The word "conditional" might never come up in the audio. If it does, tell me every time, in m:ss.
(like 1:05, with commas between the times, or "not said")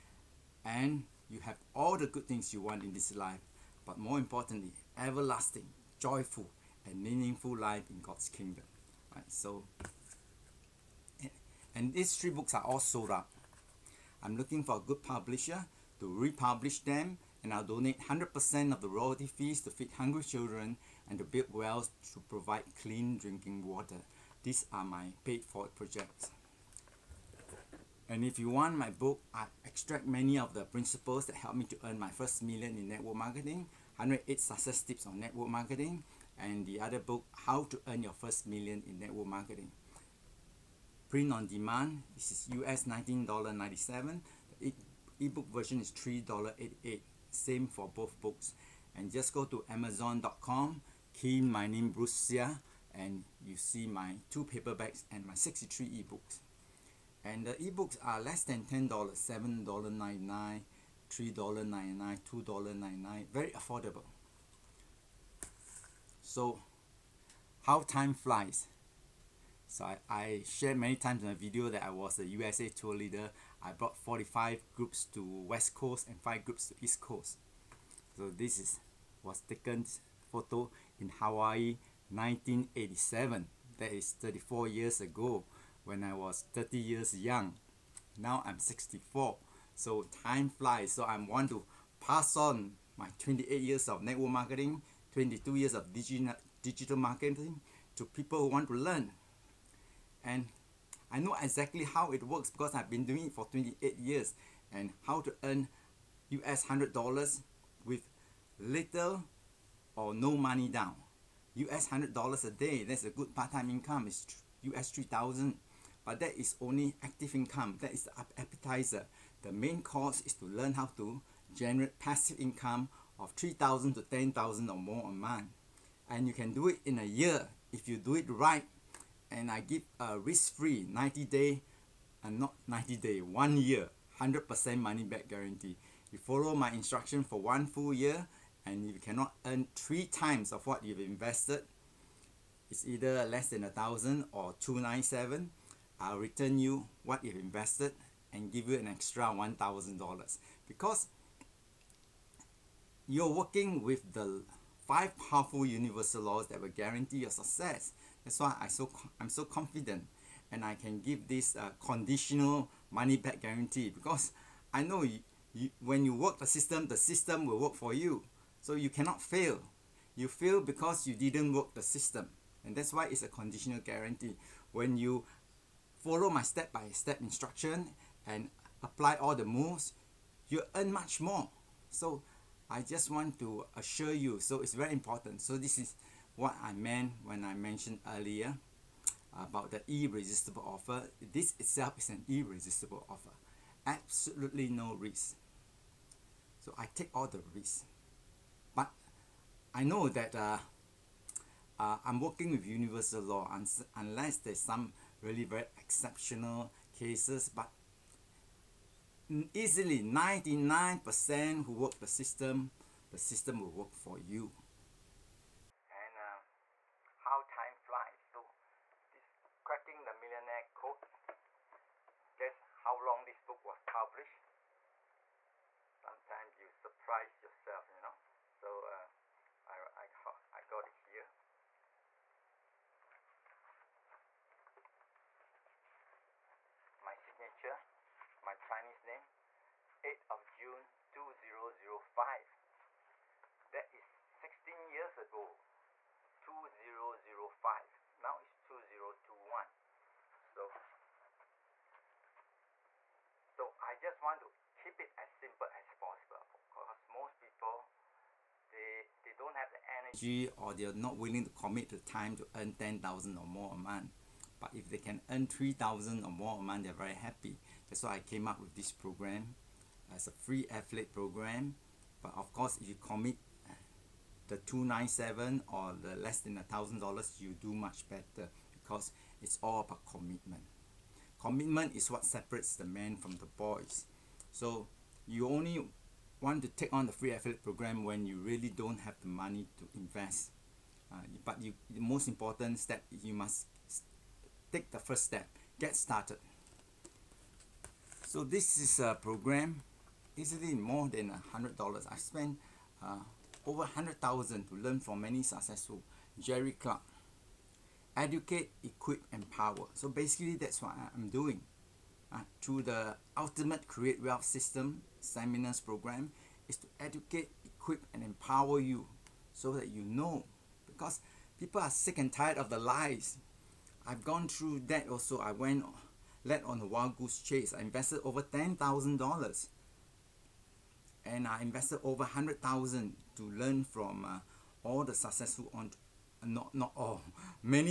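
2:41, 2:53.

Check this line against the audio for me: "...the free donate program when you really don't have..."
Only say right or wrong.
wrong.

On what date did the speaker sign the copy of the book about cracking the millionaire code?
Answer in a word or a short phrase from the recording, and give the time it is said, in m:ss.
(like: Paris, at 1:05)
8 June 2005, at 4:00.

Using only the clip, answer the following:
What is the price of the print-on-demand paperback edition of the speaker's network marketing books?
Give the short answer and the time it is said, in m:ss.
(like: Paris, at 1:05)
$19.97, at 0:42.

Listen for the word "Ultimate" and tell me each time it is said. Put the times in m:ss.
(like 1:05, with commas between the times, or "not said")
5:13.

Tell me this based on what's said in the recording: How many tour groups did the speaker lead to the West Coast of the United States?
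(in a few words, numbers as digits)
45.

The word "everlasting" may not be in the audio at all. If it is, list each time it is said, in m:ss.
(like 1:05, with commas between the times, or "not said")
0:04.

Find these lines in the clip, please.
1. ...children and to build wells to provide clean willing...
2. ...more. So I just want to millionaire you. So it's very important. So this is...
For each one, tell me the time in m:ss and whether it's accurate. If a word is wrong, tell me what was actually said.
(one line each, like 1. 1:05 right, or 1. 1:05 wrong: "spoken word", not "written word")
1. 0:20 wrong: "drinking", not "willing"
2. 3:01 wrong: "assure", not "millionaire".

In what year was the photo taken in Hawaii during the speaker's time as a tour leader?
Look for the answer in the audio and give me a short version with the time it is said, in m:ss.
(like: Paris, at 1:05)
1987, at 1:22.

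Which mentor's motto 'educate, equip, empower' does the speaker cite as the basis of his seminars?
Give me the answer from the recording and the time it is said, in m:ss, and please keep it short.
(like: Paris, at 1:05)
Jerry Clark, at 5:06.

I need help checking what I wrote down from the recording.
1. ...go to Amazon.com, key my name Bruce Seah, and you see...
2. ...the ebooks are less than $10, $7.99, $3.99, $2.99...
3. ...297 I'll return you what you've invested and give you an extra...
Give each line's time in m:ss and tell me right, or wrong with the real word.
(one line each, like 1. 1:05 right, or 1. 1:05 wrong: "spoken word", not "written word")
1. 0:49 right
2. 0:57 right
3. 2:24 right.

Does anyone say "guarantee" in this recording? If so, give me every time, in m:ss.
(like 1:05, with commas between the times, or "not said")
2:15, 2:36, 2:43, 2:53.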